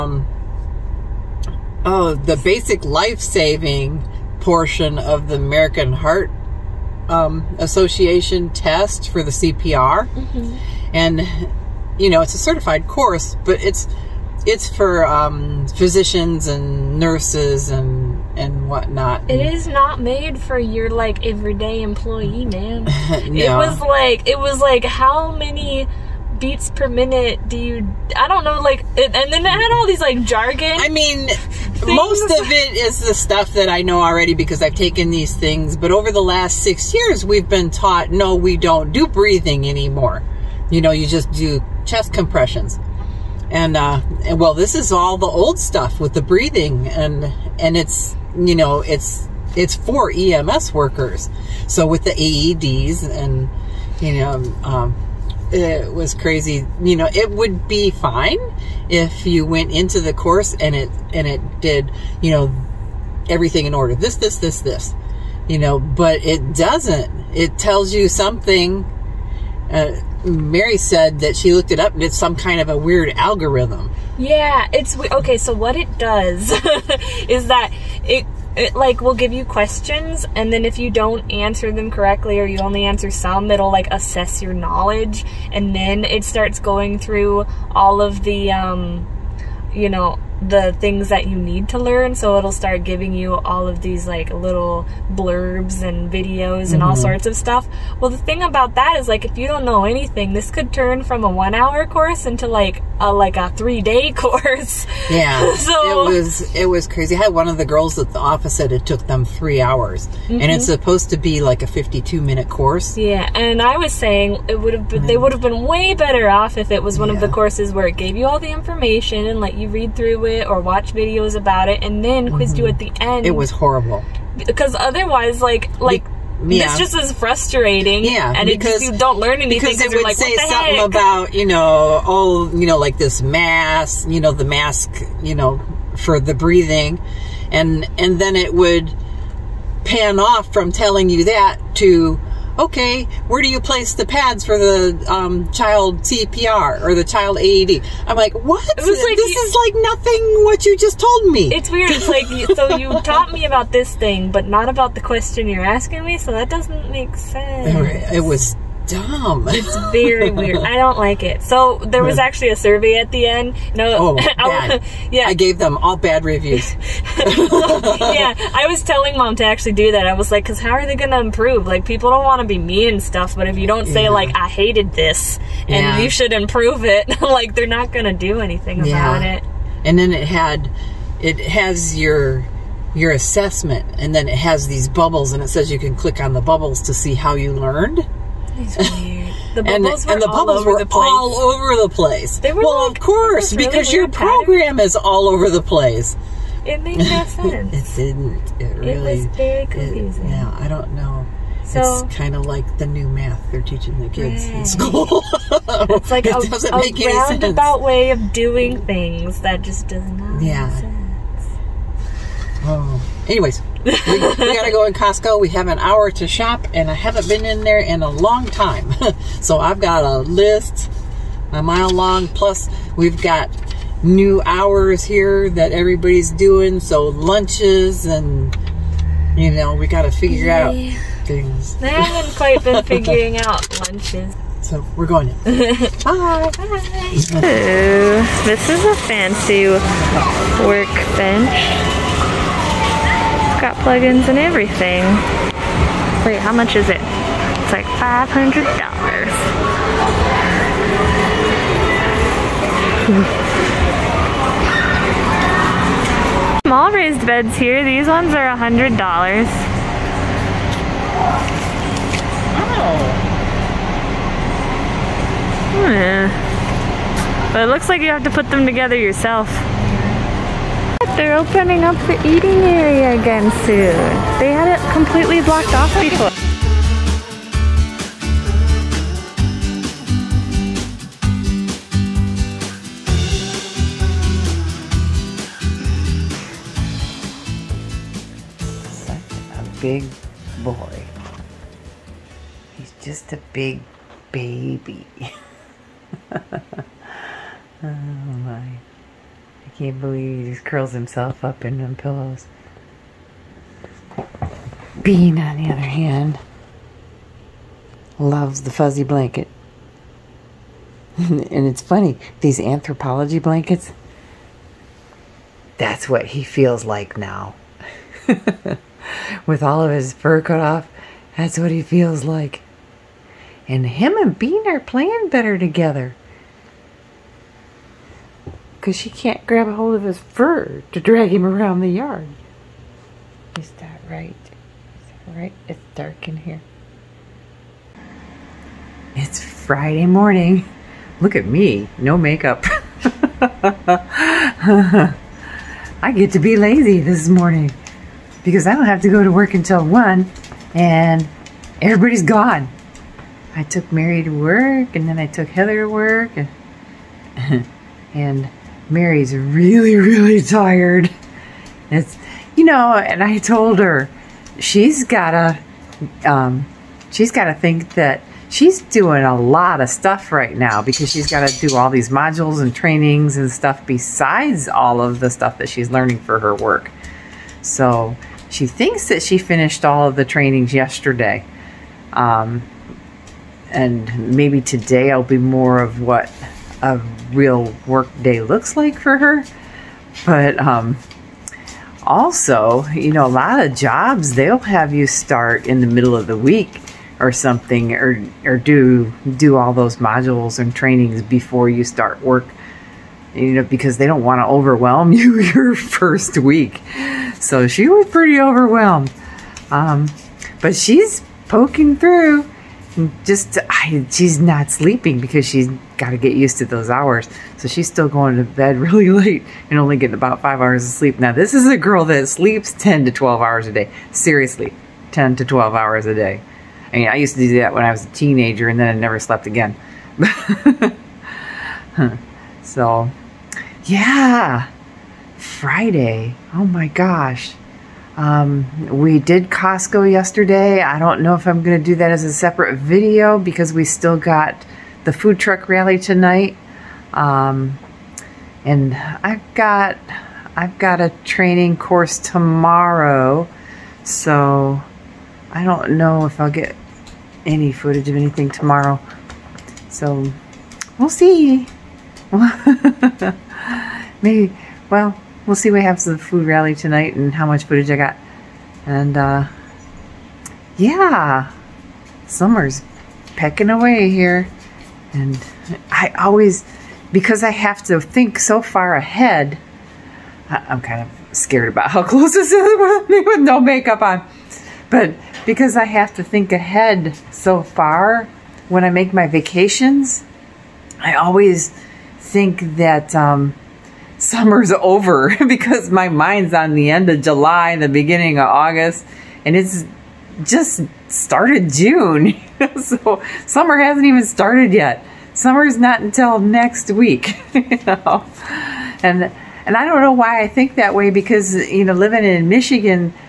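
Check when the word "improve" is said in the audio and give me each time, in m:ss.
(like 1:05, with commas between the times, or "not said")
2:51, 2:56.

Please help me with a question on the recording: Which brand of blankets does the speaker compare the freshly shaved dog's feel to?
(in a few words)
Anthropologie.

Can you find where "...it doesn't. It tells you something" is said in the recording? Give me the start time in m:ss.
1:06.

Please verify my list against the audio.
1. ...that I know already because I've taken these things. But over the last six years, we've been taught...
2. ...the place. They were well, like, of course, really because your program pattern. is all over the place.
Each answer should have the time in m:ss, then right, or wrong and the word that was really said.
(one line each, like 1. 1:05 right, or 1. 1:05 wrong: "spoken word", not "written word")
1. 0:33 right
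2. 3:11 right.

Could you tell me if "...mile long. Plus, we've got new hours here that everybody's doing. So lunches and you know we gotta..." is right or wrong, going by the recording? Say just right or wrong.
right.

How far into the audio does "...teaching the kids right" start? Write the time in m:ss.
3:23.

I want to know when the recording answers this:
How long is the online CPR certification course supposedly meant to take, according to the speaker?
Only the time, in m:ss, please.
1:51.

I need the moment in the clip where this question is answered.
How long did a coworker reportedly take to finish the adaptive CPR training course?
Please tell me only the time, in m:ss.
1:49.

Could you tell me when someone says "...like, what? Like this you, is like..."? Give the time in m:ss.
2:28.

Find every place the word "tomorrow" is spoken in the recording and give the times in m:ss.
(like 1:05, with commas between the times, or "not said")
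7:32, 7:38.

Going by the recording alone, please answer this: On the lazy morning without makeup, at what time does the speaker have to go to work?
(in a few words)
1.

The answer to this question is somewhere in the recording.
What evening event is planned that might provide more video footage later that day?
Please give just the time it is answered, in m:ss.
7:25.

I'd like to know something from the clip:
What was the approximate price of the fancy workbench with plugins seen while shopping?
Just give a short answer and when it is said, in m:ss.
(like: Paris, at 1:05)
$500, at 4:08.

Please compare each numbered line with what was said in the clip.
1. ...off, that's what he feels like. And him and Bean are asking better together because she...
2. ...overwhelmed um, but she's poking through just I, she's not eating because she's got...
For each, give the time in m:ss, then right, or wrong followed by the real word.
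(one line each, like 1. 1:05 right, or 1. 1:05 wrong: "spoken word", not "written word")
1. 5:20 wrong: "playing", not "asking"
2. 6:48 wrong: "sleeping", not "eating".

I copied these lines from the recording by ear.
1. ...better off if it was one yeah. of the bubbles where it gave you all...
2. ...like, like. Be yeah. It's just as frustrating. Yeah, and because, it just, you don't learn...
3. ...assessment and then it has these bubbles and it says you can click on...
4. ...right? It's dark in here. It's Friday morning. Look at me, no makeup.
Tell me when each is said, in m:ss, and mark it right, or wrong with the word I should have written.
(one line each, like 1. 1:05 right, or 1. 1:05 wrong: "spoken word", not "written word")
1. 1:56 wrong: "courses", not "bubbles"
2. 2:05 right
3. 3:03 right
4. 5:35 right.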